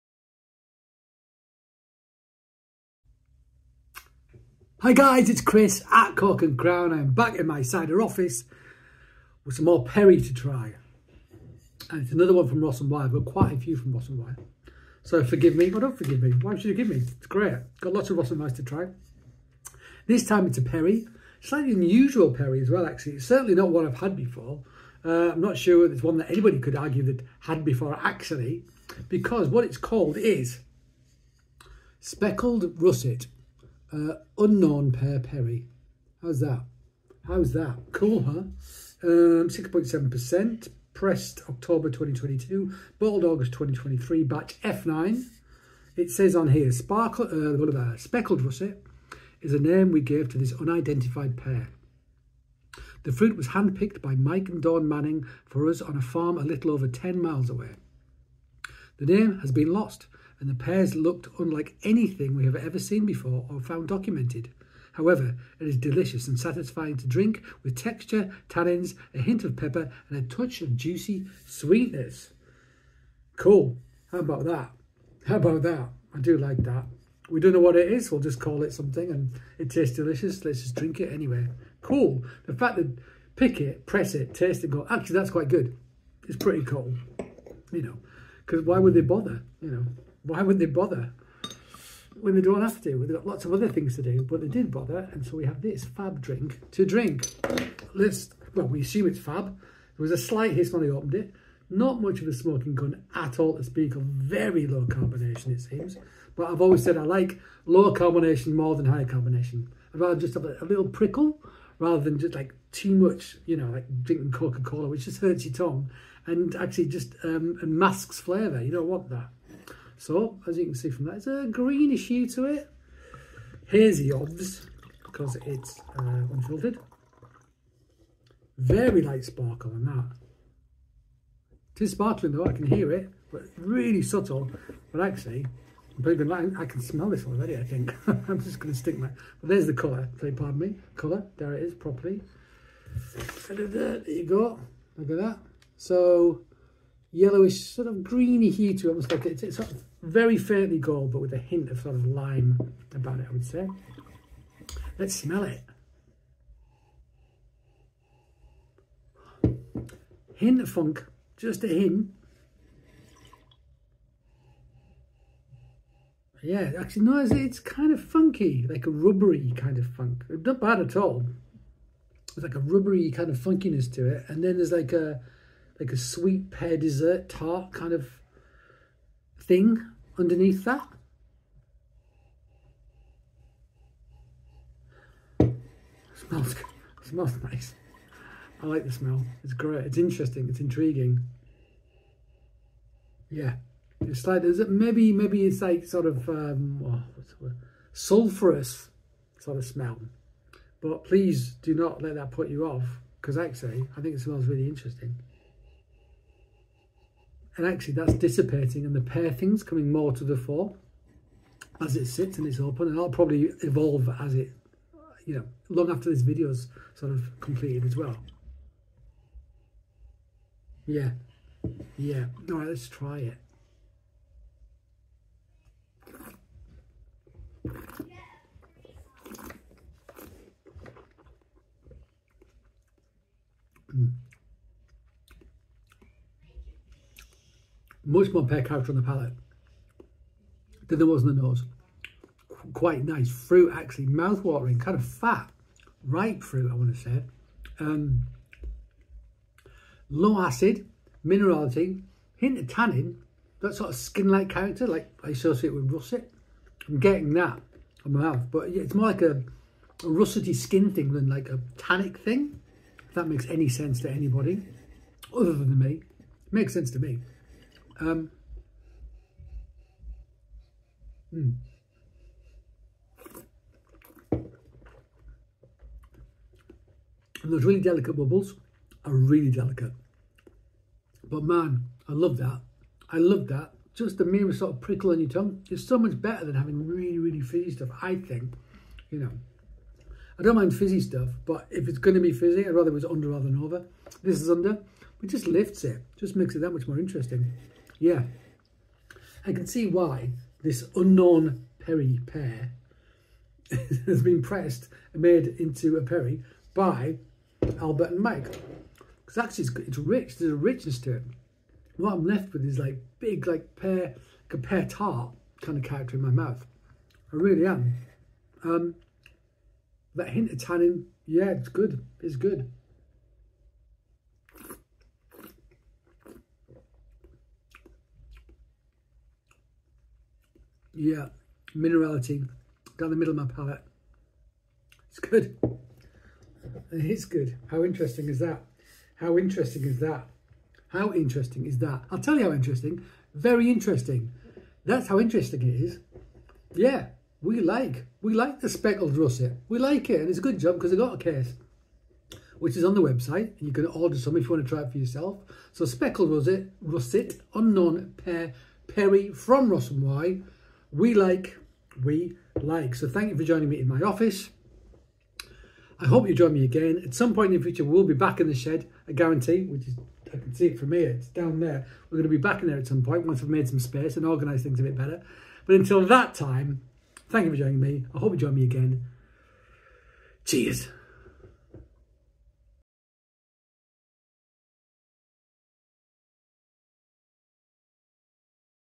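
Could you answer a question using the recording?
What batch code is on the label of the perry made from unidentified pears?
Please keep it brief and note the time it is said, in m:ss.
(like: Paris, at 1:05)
F9, at 0:44.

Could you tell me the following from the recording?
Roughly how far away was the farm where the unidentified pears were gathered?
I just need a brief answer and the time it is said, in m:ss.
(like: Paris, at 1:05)
A little over 10 miles, at 0:56.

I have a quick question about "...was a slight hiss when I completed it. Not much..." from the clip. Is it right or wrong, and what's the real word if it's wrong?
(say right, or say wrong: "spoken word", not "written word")
wrong: "opened", not "completed".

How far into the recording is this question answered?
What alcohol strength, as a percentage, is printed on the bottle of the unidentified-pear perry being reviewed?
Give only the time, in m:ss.
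0:39.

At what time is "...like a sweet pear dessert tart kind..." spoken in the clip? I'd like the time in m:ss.
2:55.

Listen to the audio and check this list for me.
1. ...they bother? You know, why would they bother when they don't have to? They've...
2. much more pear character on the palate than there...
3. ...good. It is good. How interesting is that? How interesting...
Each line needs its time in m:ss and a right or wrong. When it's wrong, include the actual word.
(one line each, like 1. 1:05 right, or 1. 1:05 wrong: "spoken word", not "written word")
1. 1:28 right
2. 3:58 right
3. 5:35 right.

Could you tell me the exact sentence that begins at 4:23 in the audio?
If that makes any sense to anybody, other than me, it makes sense to me.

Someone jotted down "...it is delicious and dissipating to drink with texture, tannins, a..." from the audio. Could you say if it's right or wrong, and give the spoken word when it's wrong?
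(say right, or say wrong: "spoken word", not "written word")
wrong: "satisfying", not "dissipating".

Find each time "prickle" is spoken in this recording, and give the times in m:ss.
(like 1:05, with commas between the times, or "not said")
1:50, 4:44.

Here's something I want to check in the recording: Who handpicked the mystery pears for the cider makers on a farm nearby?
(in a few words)
Mike and Dawn Manning.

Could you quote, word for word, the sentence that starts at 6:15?
But until that time, thank you for joining me.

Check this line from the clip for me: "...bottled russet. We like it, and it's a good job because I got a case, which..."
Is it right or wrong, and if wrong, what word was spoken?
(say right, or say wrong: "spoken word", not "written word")
wrong: "speckled", not "bottled".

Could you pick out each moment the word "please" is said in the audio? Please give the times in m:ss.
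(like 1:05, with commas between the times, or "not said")
2:20, 3:21.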